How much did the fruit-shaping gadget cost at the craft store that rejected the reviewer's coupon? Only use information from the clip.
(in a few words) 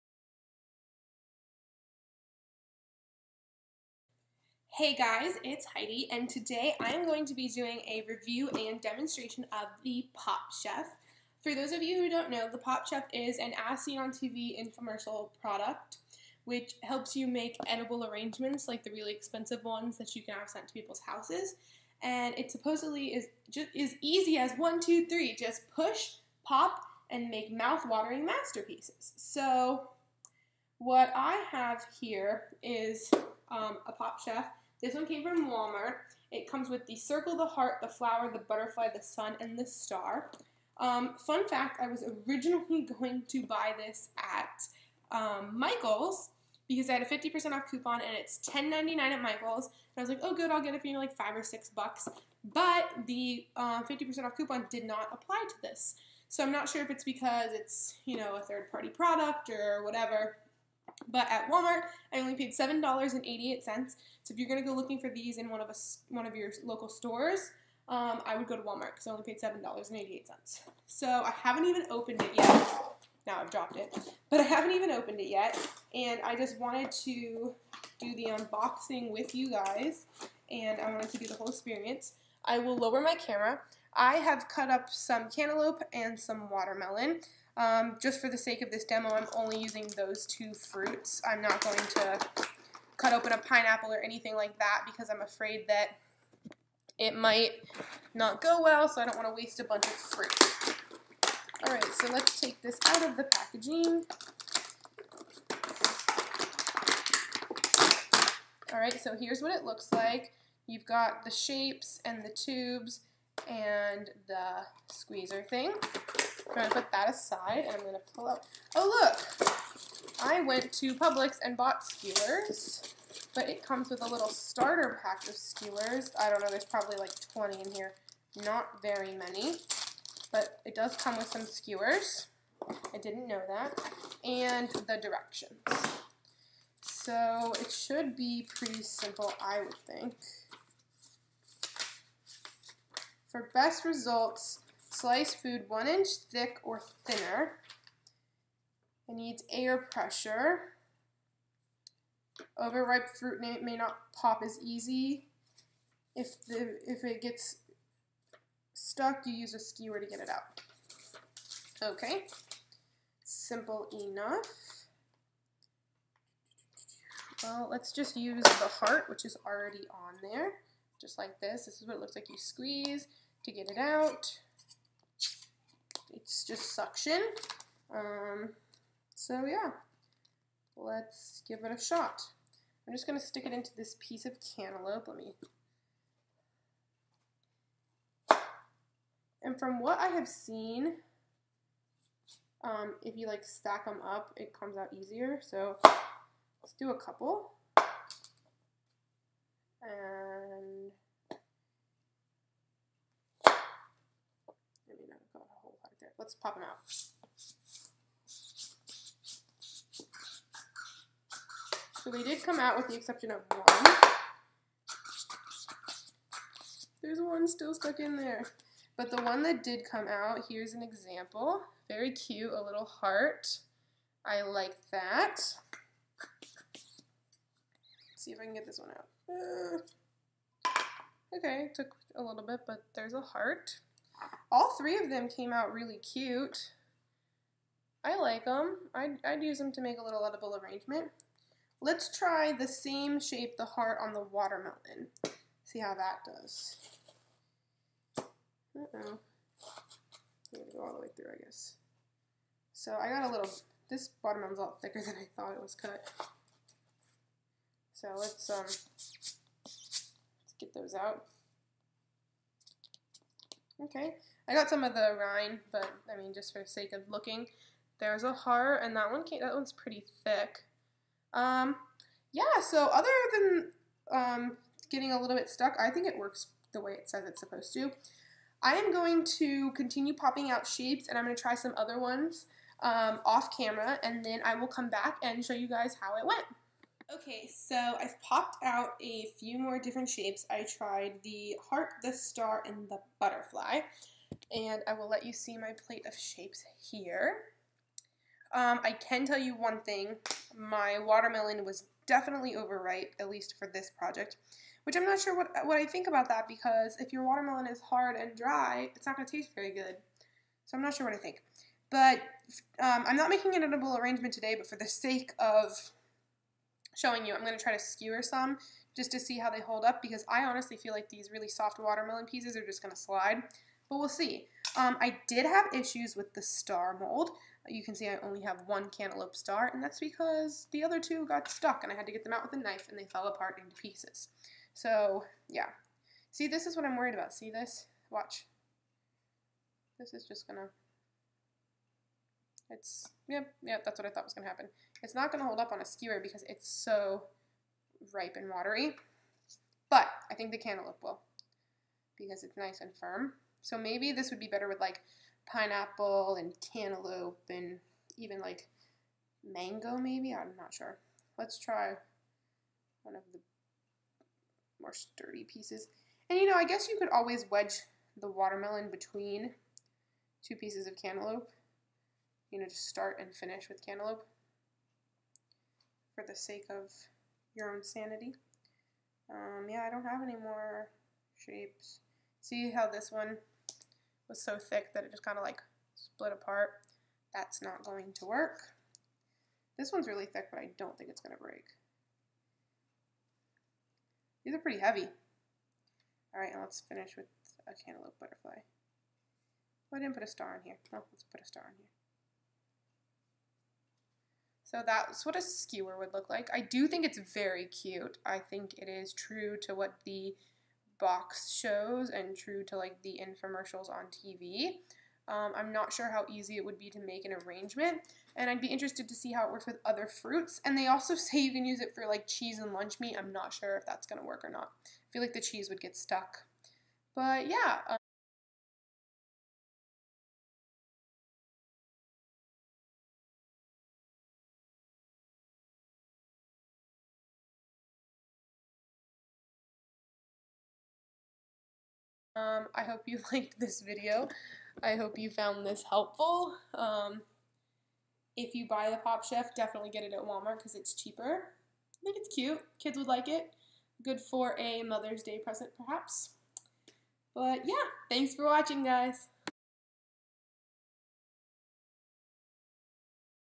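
$10.99.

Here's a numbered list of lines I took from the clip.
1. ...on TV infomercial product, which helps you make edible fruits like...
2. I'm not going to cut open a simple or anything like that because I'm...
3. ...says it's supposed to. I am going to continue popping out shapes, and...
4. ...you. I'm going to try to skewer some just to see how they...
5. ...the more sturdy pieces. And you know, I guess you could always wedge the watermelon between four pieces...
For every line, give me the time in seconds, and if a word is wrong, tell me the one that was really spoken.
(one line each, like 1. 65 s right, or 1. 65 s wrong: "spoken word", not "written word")
1. 13 s wrong: "arrangements", not "fruits"
2. 91 s wrong: "pineapple", not "simple"
3. 277 s right
4. 317 s right
5. 363 s wrong: "two", not "four".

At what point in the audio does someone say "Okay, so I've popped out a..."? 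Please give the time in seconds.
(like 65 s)
287 s.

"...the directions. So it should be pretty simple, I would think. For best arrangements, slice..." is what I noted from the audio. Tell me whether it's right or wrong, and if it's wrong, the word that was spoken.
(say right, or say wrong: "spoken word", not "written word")
wrong: "results", not "arrangements".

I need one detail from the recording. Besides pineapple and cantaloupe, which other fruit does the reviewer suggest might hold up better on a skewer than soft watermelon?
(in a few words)
Mango.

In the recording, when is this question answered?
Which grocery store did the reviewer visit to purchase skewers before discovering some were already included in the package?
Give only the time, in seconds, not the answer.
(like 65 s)
120 s.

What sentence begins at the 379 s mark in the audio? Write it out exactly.
Um, yeah, I don't have any more shapes.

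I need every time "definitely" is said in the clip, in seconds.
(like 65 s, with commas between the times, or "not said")
302 s, 449 s.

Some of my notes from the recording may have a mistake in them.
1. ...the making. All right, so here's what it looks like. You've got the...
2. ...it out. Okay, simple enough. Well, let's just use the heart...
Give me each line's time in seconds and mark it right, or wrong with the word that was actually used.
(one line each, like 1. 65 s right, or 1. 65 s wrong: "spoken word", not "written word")
1. 103 s wrong: "packaging", not "making"
2. 160 s right.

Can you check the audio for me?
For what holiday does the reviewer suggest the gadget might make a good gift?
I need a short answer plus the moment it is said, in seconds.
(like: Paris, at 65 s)
Mother's Day, at 454 s.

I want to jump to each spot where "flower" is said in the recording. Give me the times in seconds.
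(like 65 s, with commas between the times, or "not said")
37 s.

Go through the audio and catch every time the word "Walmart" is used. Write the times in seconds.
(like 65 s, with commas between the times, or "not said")
35 s, 61 s, 68 s, 450 s.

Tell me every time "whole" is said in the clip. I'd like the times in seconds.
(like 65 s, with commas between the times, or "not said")
81 s, 205 s.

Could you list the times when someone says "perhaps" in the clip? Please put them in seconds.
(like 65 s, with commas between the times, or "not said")
455 s.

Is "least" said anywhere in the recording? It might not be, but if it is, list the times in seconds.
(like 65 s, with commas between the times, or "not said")
303 s.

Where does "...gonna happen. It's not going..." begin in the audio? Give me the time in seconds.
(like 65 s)
344 s.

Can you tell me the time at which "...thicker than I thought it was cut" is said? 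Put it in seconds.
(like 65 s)
254 s.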